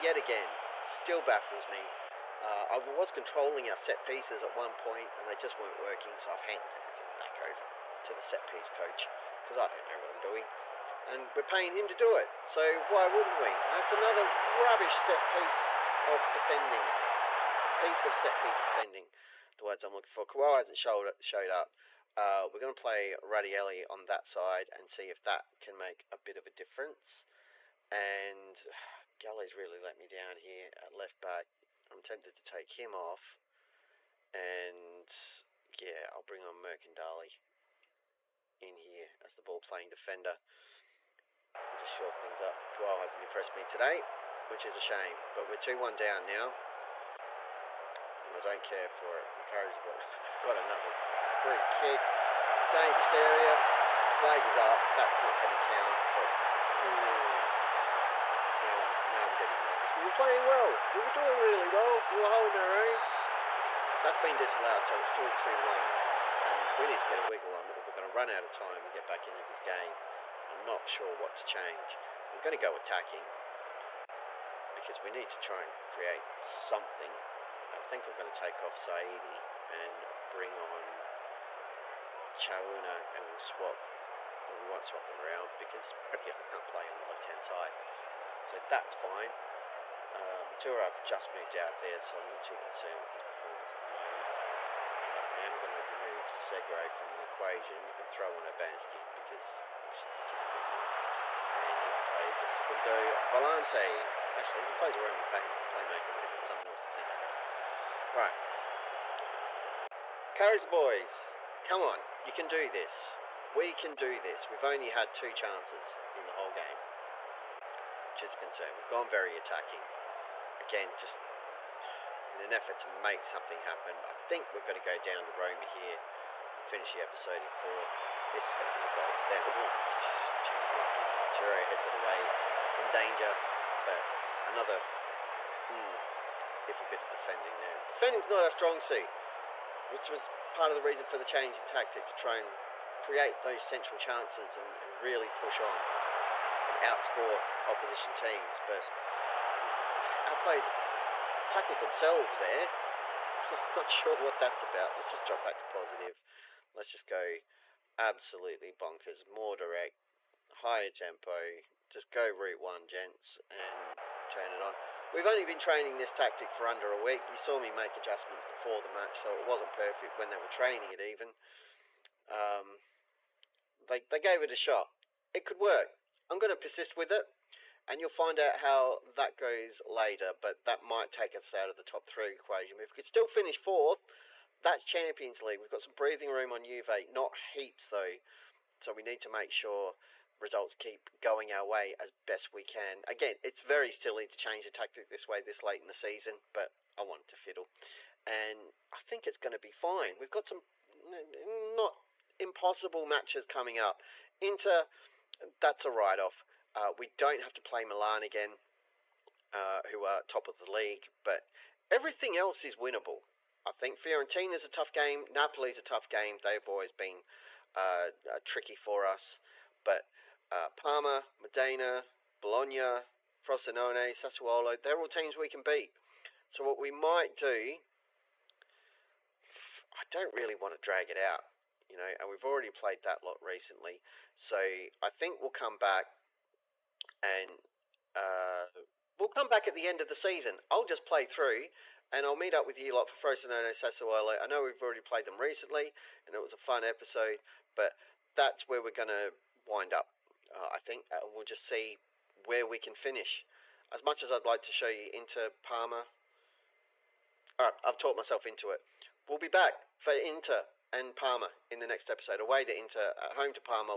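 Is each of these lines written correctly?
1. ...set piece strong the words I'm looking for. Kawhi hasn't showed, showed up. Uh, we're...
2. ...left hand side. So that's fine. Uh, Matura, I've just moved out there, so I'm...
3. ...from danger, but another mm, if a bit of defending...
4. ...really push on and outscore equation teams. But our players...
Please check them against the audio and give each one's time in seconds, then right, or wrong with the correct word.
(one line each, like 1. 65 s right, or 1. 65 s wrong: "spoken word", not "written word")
1. 18 s wrong: "defending", not "strong"
2. 87 s right
3. 132 s right
4. 145 s wrong: "opposition", not "equation".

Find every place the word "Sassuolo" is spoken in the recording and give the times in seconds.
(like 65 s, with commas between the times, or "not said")
224 s, 243 s.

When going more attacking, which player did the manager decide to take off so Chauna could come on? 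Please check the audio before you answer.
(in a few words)
Saidi.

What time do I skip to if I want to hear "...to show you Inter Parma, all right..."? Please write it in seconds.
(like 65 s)
254 s.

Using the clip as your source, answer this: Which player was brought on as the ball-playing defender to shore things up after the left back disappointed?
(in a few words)
Mercandali.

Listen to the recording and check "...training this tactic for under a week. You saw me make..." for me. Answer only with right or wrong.
right.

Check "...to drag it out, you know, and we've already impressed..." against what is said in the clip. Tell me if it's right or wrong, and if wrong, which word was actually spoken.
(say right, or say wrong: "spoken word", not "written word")
wrong: "played", not "impressed".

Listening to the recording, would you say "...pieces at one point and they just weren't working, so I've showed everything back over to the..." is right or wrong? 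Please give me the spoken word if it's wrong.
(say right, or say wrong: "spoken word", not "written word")
wrong: "handed", not "showed".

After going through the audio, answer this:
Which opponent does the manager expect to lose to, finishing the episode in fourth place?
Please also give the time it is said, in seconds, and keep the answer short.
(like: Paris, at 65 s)
Roma, at 125 s.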